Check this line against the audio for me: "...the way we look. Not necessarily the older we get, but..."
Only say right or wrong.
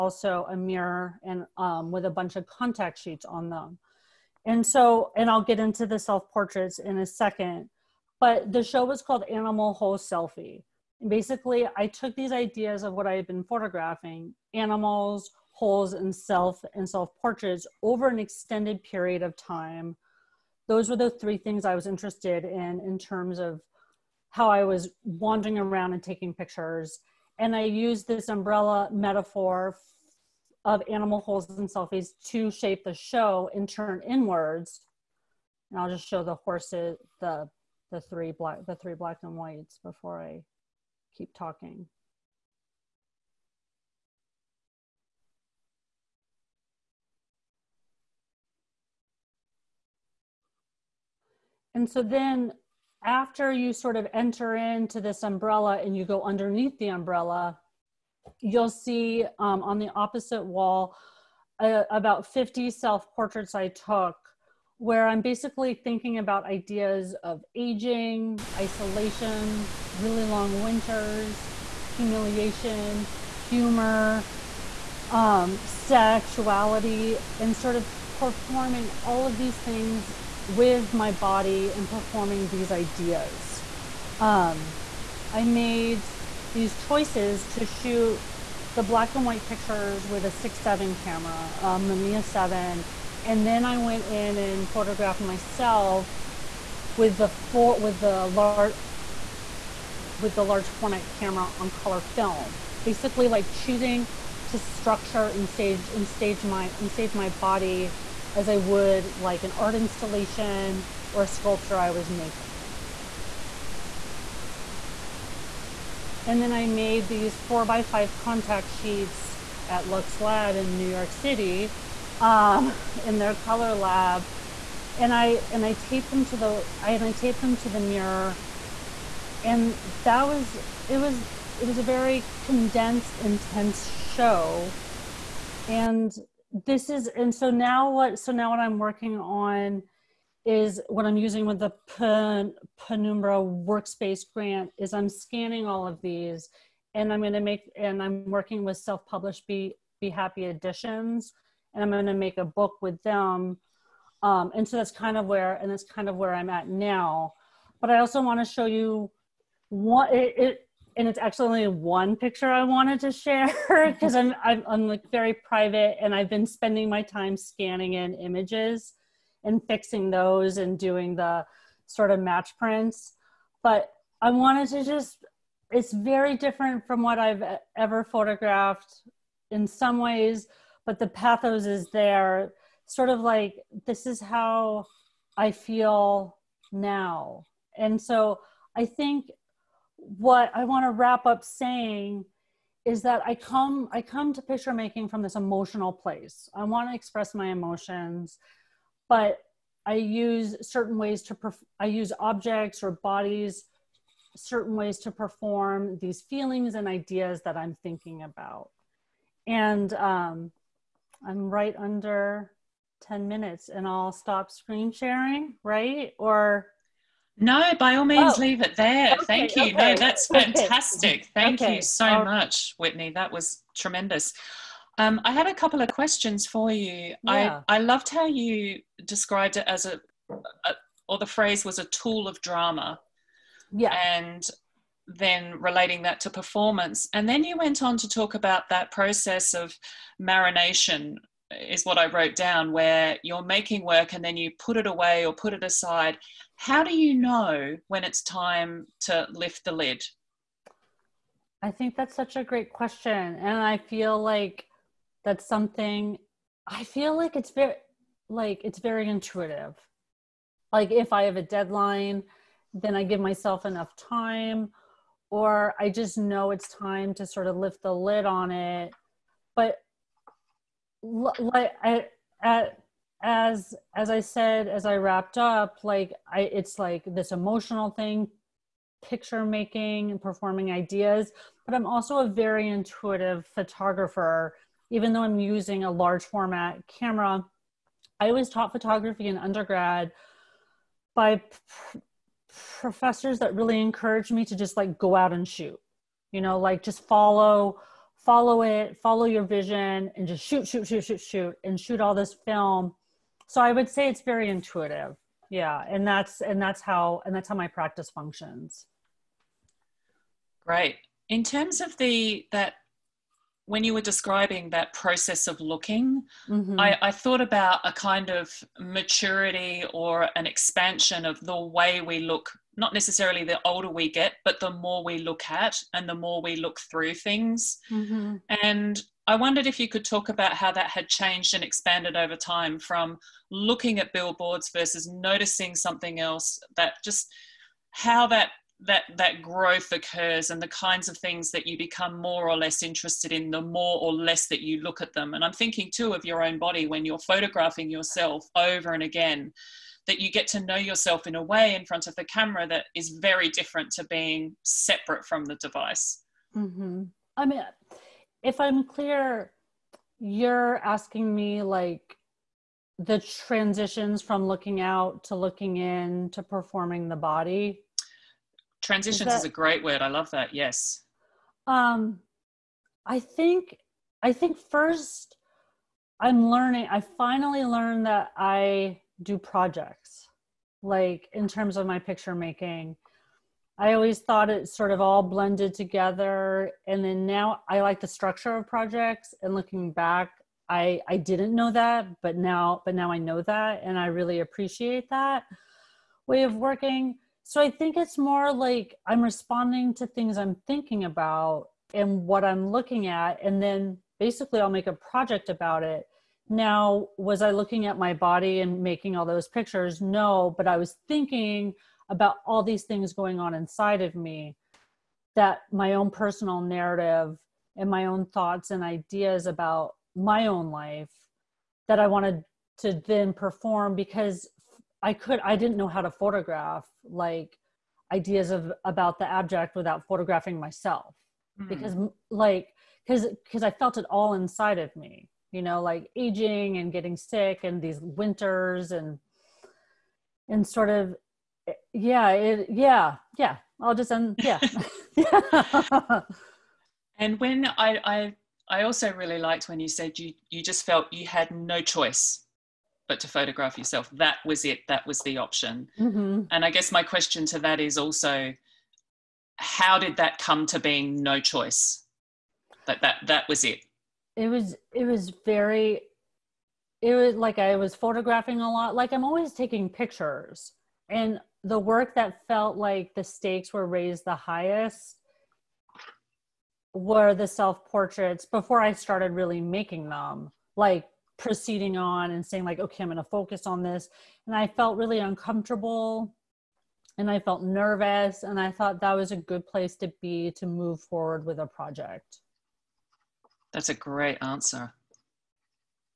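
right.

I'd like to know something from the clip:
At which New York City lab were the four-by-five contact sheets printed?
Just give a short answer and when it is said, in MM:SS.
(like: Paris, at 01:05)
Lux Lab, at 01:59.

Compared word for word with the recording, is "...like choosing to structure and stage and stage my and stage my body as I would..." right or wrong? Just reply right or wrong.
right.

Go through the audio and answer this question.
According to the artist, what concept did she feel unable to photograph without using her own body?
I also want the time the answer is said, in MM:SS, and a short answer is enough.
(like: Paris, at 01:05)
the abject, at 07:09.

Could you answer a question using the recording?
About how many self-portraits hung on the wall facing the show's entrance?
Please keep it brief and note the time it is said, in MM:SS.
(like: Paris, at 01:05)
50, at 01:02.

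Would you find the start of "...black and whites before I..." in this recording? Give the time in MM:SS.
00:38.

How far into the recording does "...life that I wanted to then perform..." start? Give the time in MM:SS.
07:00.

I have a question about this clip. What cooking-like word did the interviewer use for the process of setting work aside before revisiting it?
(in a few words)
marination.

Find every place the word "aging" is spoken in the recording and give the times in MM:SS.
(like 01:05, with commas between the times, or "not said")
01:07, 07:16.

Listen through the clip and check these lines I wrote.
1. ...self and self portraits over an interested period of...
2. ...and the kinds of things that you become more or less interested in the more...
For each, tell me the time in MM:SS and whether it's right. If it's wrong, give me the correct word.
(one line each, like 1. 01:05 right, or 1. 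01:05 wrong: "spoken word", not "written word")
1. 00:16 wrong: "extended", not "interested"
2. 05:40 right.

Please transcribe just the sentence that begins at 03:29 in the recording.
And um, I'm right under 10 minutes and I'll stop screen sharing, right?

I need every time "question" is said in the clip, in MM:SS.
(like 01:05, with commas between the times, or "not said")
03:45, 04:12, 07:37.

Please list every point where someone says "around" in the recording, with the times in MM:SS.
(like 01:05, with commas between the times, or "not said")
00:25.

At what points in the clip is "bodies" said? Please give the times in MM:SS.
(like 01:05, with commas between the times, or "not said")
03:22.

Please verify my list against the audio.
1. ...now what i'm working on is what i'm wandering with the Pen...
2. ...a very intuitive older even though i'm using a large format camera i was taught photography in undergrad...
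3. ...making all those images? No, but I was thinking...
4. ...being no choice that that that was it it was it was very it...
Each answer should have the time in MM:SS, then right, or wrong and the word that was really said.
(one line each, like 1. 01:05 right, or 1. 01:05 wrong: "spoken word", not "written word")
1. 02:18 wrong: "using", not "wandering"
2. 04:42 wrong: "photographer", not "older"
3. 06:48 wrong: "pictures", not "images"
4. 07:40 right.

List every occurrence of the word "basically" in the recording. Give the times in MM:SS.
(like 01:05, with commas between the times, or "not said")
00:11, 01:05, 01:42, 06:44.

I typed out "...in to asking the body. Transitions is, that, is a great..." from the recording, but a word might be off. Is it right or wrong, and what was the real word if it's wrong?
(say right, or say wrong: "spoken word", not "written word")
wrong: "performing", not "asking".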